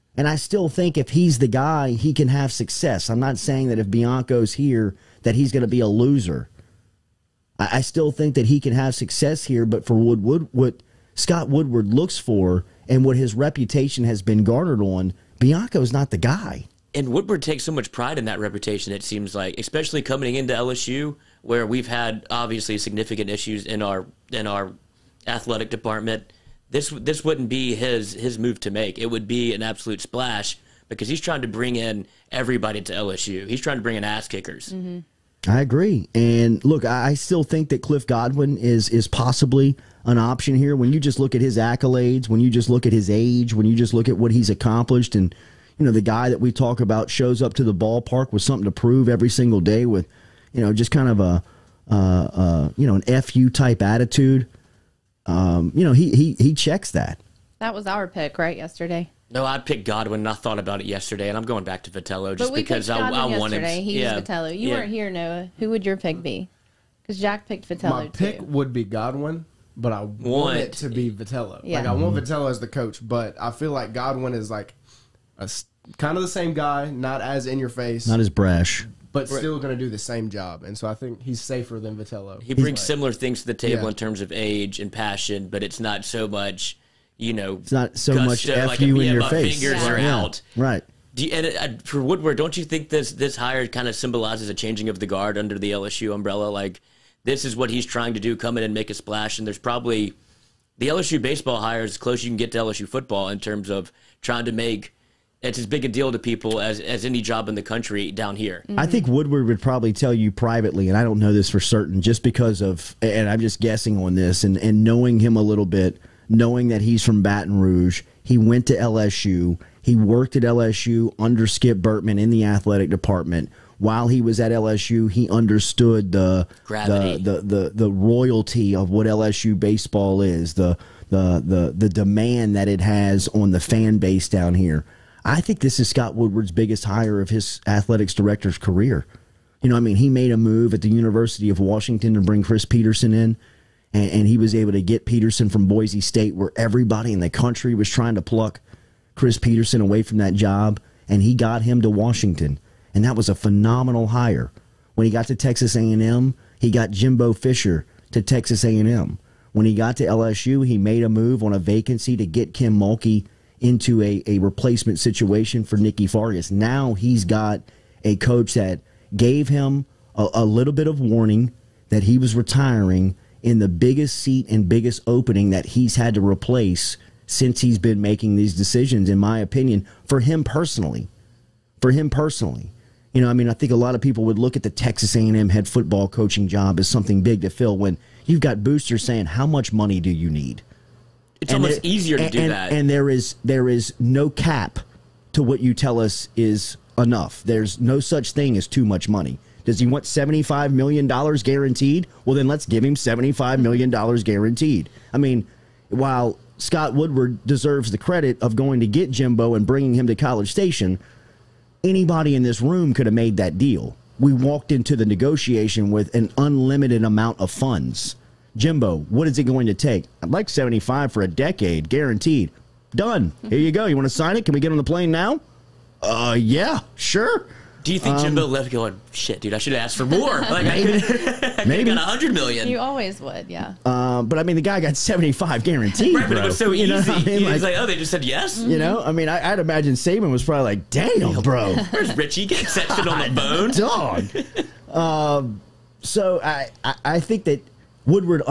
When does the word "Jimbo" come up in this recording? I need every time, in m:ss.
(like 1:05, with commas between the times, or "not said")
2:36, 3:29, 3:38, 3:48.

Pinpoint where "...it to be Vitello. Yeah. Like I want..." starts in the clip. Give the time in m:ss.
1:10.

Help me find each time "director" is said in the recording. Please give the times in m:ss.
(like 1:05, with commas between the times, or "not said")
2:18.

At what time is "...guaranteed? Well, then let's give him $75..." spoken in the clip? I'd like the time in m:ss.
3:21.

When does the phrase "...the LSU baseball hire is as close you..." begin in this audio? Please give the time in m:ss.
1:40.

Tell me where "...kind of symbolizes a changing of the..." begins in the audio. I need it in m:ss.
1:33.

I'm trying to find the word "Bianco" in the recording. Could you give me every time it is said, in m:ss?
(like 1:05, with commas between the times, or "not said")
0:03, 0:15.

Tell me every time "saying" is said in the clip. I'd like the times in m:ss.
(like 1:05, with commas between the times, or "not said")
0:03, 3:09.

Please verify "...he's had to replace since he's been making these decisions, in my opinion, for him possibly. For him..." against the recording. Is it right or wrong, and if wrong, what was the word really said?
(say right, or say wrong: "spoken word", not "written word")
wrong: "personally", not "possibly".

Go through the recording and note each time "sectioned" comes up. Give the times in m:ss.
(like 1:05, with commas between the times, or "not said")
4:02.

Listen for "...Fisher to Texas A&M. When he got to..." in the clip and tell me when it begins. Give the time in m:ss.
2:37.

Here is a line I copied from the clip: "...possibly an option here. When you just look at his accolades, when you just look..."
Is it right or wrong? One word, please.
right.